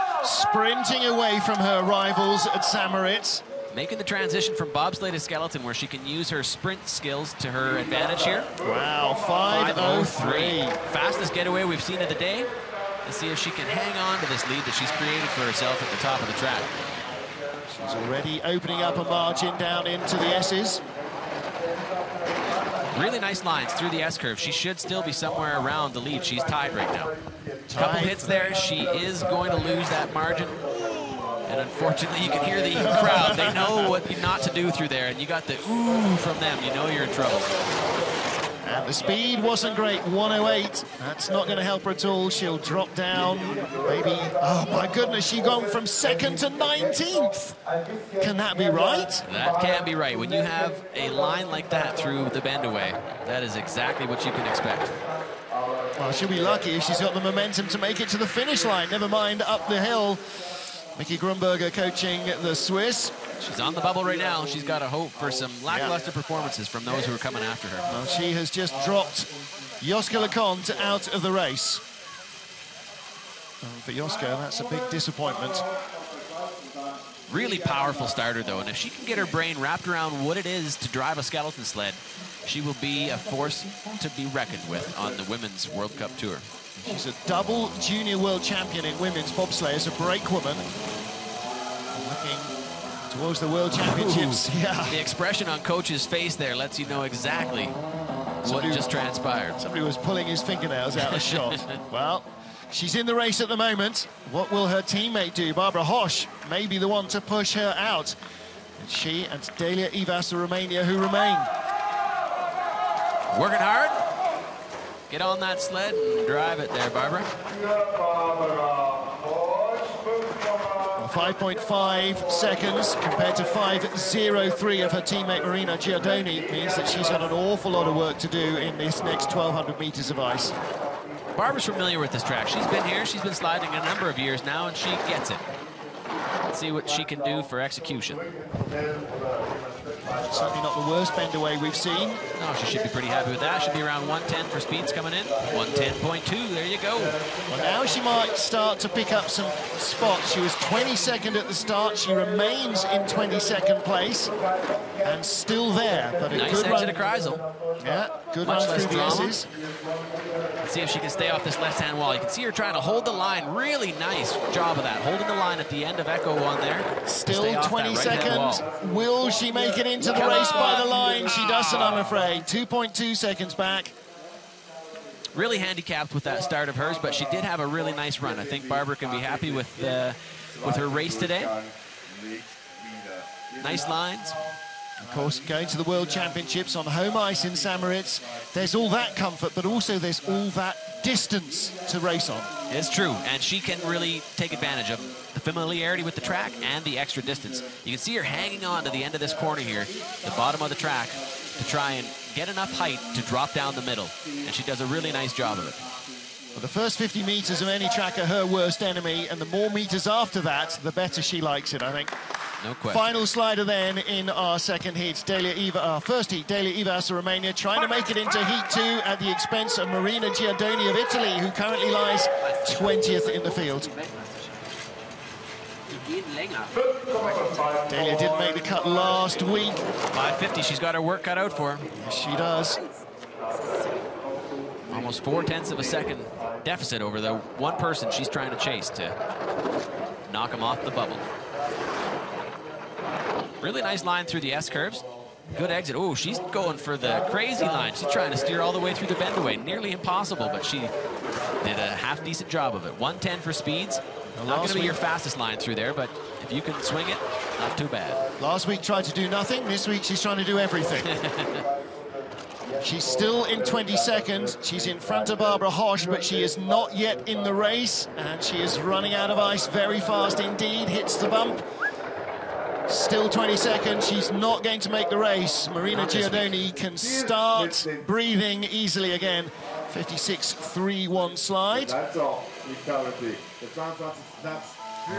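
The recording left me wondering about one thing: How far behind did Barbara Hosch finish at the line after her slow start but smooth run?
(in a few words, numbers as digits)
2.2 seconds.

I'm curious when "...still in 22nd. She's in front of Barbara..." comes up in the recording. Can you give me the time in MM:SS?
04:23.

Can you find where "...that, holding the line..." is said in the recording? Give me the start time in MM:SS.
02:44.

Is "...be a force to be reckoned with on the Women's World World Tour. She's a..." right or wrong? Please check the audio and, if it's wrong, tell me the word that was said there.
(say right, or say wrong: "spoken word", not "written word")
wrong: "Cup", not "World".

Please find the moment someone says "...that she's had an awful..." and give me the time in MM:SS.
02:06.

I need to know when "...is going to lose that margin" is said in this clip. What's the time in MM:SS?
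00:28.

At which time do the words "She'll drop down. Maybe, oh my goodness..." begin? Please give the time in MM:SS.
00:42.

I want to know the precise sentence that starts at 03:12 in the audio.
It's true, and she can really take advantage of the familiarity with the track and the extra distance.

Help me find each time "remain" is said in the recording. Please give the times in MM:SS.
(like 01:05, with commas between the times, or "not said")
01:50, 02:32.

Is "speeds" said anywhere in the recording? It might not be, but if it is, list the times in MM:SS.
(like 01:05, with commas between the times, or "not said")
00:38, 02:24, 04:13.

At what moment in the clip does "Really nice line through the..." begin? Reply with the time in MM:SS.
04:03.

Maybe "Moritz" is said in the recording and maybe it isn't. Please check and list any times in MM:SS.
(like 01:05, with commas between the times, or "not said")
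00:02, 03:07.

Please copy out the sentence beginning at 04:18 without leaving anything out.
Last week tried to do nothing.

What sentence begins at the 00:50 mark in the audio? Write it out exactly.
When you have a line like that through the bend away, that is exactly what you can expect.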